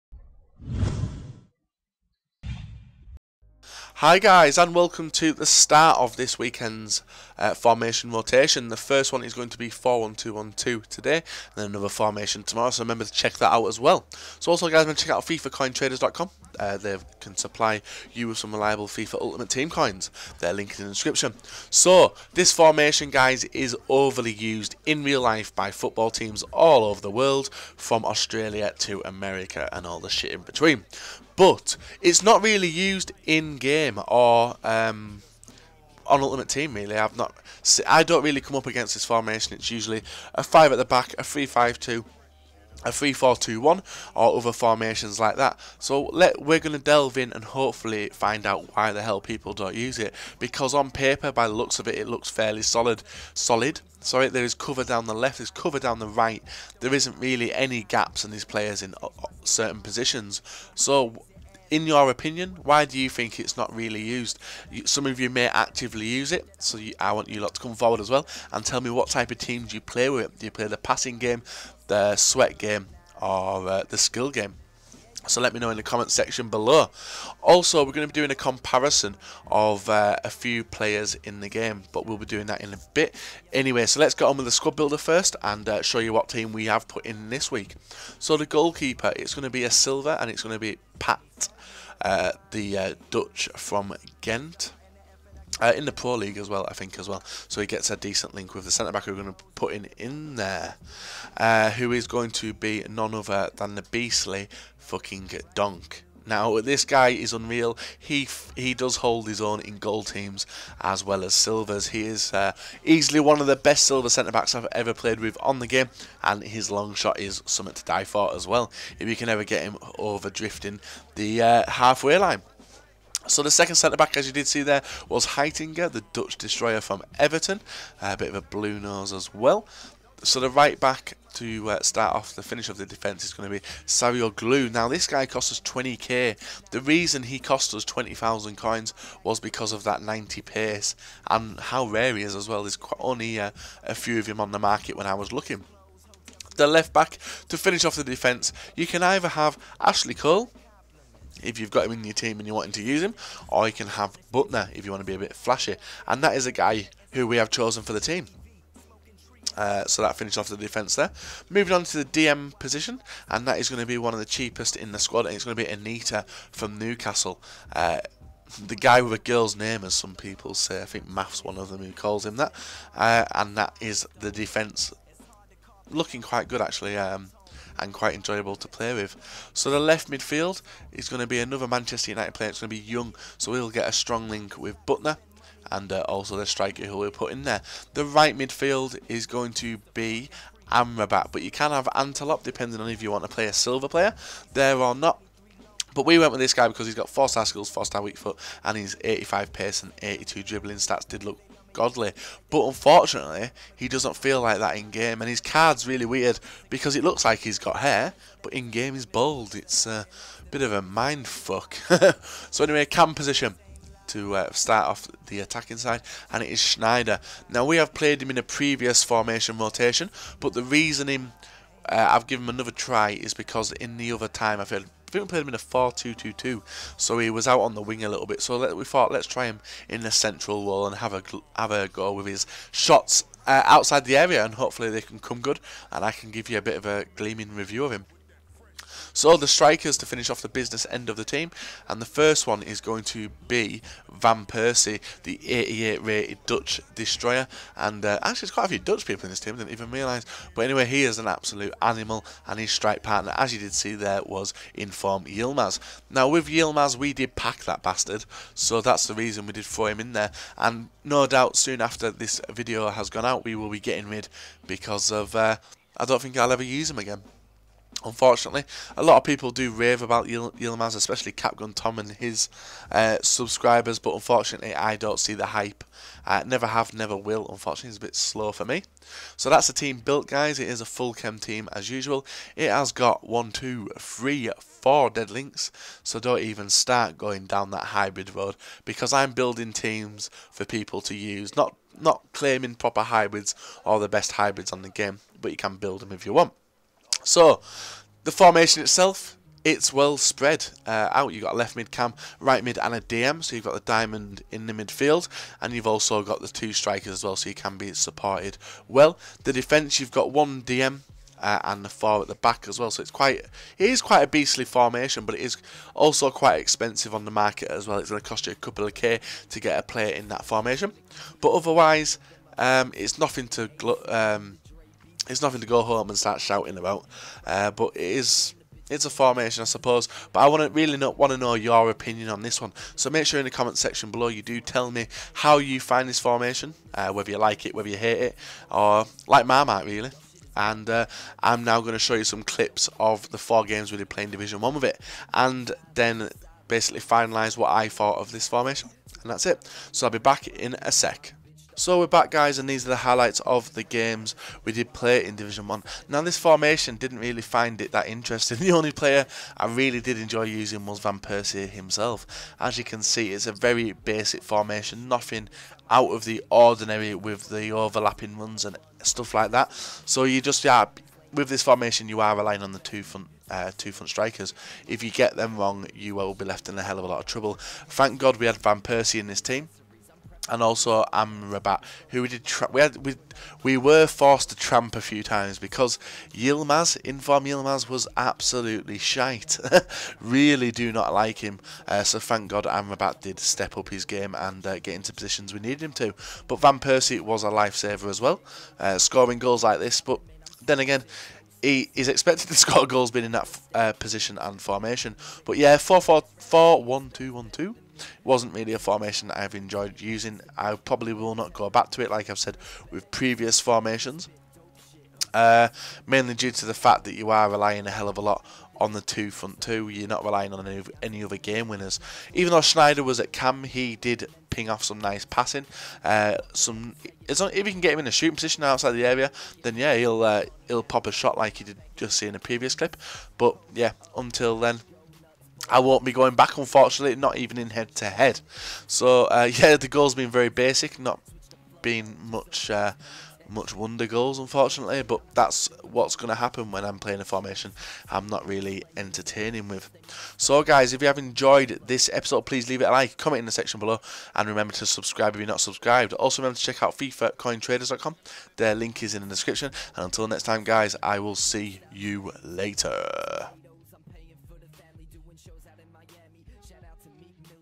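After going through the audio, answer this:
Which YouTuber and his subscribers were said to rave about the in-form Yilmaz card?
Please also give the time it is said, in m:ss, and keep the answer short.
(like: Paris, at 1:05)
Capgun Tom, at 4:31.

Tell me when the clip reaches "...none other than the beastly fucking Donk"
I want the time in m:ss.
1:42.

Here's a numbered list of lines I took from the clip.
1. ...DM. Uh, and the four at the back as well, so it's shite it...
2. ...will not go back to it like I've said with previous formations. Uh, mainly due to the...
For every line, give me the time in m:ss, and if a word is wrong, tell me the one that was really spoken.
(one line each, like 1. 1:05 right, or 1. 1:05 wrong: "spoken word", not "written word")
1. 5:10 wrong: "quite", not "shite"
2. 6:51 right.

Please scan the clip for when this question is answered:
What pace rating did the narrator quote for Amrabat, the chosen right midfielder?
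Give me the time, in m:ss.
3:19.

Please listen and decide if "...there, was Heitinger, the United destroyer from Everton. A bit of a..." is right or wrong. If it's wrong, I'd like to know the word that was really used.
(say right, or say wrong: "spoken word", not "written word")
wrong: "Dutch", not "United".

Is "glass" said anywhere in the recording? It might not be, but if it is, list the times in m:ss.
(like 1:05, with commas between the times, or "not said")
not said.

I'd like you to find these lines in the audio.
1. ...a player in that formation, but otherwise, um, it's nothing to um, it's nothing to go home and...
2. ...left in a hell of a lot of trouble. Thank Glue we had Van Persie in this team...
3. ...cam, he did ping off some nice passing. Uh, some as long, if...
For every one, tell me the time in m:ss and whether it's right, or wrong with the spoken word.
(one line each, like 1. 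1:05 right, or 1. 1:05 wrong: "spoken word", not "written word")
1. 5:19 right
2. 6:16 wrong: "God", not "Glue"
3. 7:03 right.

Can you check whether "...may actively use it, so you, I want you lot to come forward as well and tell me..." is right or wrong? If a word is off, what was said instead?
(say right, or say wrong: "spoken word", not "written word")
right.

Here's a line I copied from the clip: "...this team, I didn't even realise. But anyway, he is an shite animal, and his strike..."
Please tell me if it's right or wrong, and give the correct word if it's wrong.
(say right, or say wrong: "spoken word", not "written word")
wrong: "absolute", not "shite".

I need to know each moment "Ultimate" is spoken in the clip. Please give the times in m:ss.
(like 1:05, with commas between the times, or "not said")
0:19, 0:36.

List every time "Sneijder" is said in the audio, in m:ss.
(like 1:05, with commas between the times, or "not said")
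3:36, 7:02.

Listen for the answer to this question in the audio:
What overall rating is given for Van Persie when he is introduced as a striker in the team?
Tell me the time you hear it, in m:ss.
4:05.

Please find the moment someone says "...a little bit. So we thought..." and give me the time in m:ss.
3:48.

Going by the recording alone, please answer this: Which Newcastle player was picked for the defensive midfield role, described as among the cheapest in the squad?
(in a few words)
Anita.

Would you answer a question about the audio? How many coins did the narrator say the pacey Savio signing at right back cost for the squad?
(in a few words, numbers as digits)
20,000.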